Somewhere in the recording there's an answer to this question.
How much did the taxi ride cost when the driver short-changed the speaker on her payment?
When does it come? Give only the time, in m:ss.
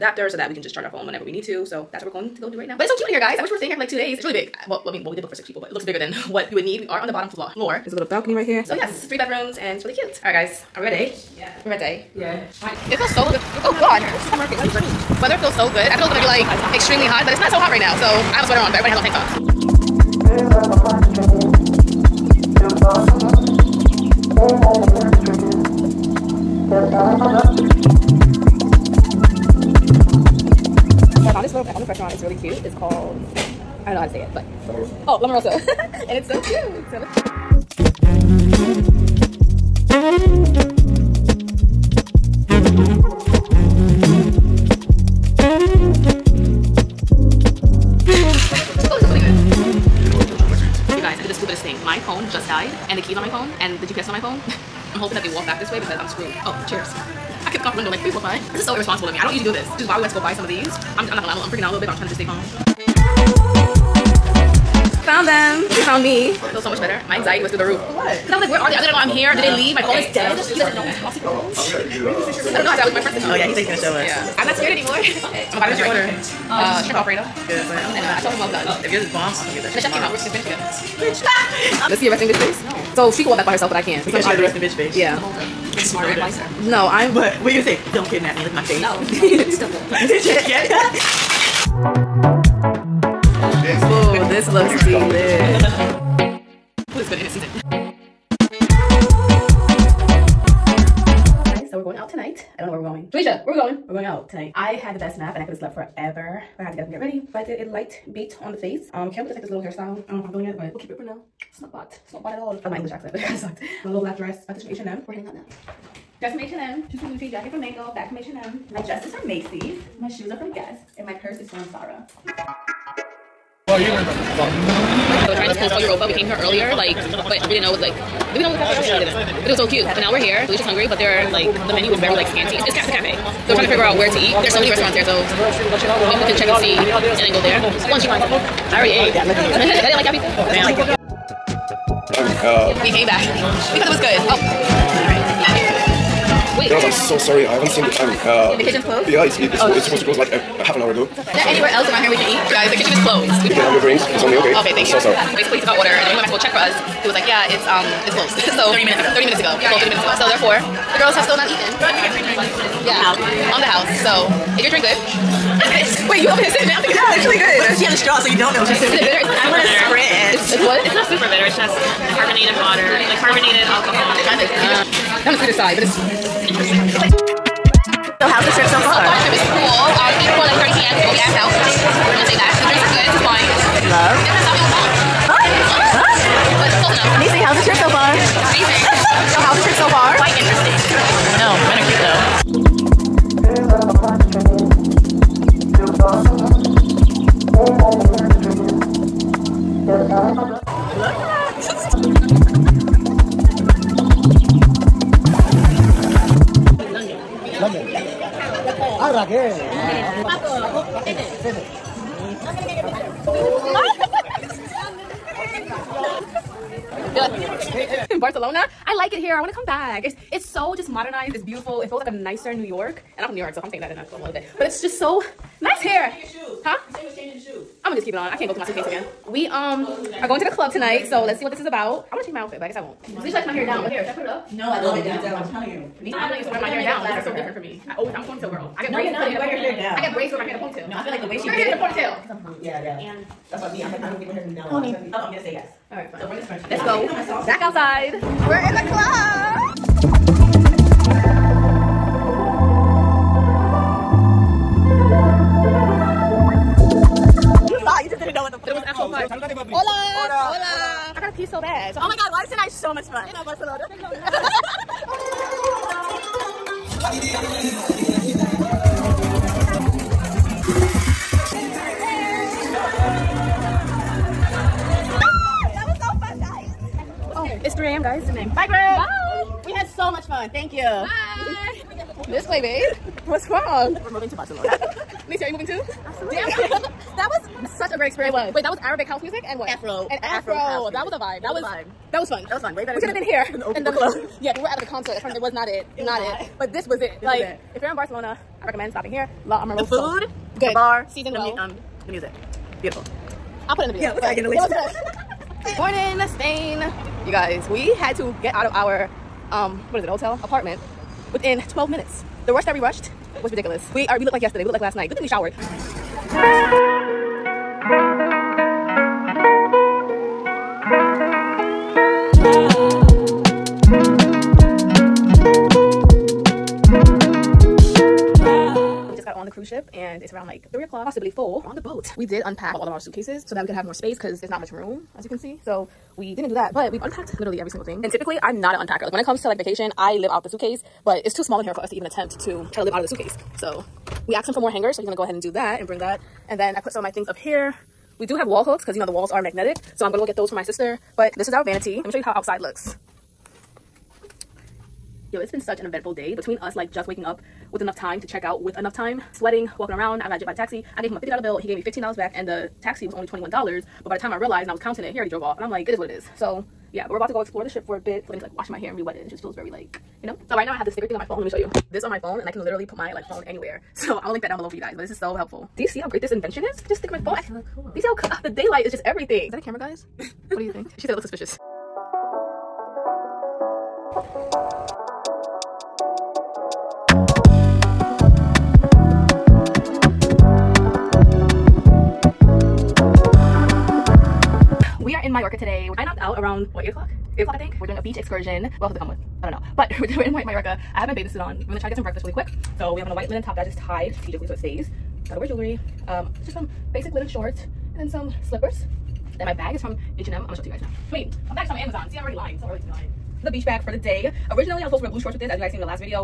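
6:03.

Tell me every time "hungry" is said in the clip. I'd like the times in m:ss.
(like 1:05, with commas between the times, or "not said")
2:10, 4:02.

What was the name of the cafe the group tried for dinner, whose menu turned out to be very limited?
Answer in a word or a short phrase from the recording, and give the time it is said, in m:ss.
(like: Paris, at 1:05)
Europa, at 2:05.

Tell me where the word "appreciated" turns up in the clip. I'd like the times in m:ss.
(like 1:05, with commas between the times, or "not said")
not said.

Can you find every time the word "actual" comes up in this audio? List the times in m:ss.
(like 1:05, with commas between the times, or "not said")
4:18.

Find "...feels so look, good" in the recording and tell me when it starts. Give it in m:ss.
0:12.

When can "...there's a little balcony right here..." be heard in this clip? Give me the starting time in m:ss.
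0:07.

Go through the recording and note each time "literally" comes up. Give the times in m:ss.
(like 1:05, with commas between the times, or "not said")
5:37, 6:12.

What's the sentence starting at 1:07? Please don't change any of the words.
My anxiety was through the roof.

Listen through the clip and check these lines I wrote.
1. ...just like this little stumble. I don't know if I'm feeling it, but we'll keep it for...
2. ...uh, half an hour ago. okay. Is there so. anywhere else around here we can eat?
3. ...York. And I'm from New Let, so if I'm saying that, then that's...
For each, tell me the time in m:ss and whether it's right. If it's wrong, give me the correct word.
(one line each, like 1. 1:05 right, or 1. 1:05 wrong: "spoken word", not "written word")
1. 1:49 wrong: "hairstyle", not "stumble"
2. 2:30 right
3. 3:42 wrong: "York", not "Let".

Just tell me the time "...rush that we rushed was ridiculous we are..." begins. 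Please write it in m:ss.
5:12.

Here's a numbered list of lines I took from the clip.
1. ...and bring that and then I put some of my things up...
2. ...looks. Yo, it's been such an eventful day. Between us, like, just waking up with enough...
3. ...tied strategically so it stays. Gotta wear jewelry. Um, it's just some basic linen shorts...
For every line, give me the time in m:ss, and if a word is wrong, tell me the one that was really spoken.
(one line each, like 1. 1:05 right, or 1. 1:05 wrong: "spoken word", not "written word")
1. 5:45 right
2. 5:52 right
3. 6:43 right.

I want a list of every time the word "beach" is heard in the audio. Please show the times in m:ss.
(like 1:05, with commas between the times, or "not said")
6:37, 6:53.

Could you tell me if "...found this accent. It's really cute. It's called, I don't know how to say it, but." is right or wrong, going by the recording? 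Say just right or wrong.
wrong.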